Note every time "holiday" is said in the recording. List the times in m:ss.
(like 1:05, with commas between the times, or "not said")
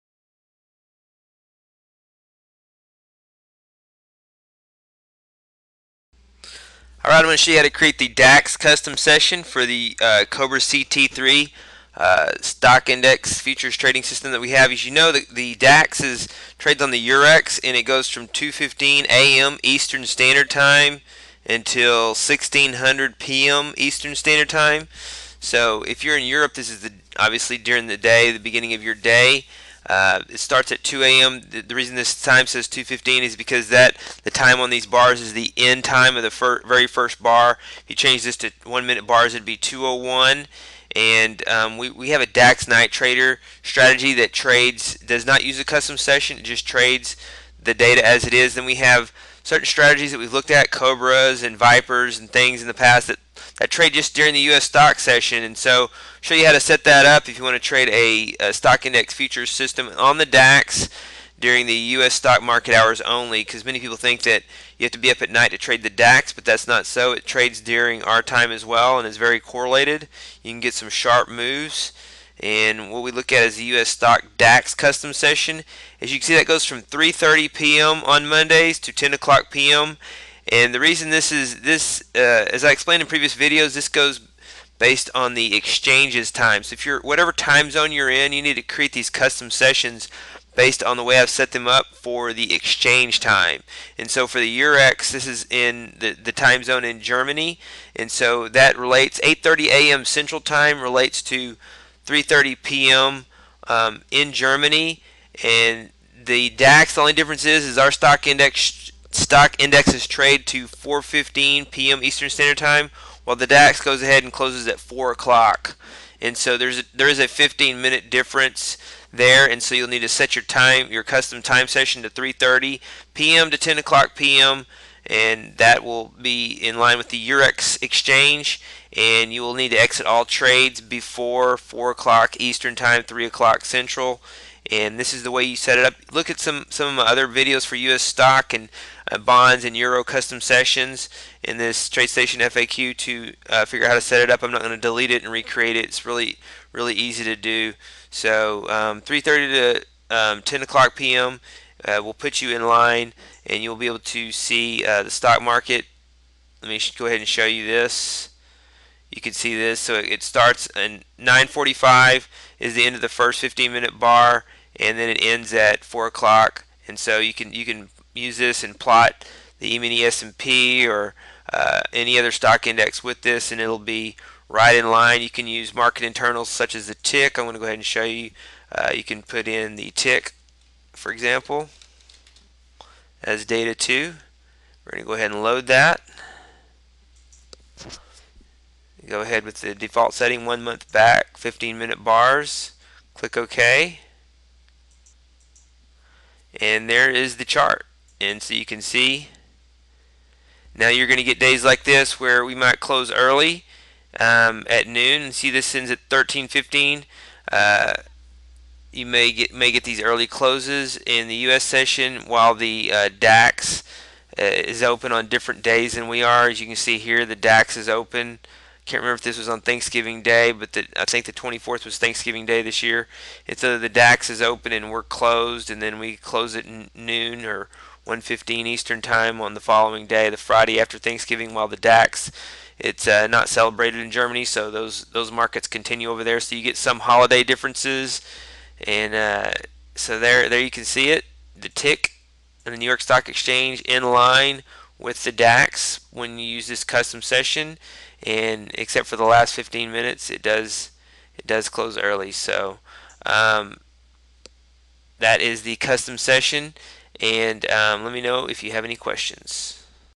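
3:57.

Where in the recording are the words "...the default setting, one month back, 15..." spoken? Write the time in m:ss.
3:09.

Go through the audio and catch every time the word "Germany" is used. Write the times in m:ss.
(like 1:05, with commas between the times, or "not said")
1:36, 1:44, 3:54.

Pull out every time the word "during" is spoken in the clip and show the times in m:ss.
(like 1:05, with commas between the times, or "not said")
0:27, 0:54, 1:01, 1:07.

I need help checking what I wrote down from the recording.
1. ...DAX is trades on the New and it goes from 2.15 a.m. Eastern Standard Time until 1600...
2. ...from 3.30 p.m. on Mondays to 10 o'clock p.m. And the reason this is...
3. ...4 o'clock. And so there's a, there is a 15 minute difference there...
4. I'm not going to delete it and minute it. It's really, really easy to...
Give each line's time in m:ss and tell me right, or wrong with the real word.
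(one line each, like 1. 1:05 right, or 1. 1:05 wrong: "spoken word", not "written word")
1. 0:15 wrong: "Eurex", not "New"
2. 1:16 right
3. 1:54 right
4. 2:24 wrong: "recreate", not "minute".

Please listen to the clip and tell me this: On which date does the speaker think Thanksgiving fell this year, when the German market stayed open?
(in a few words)
the 24th.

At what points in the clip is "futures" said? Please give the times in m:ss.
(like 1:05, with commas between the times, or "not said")
0:13, 0:59.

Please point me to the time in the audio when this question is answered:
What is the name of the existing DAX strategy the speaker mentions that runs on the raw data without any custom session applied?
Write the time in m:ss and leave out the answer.
0:42.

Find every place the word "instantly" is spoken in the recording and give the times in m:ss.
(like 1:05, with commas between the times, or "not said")
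not said.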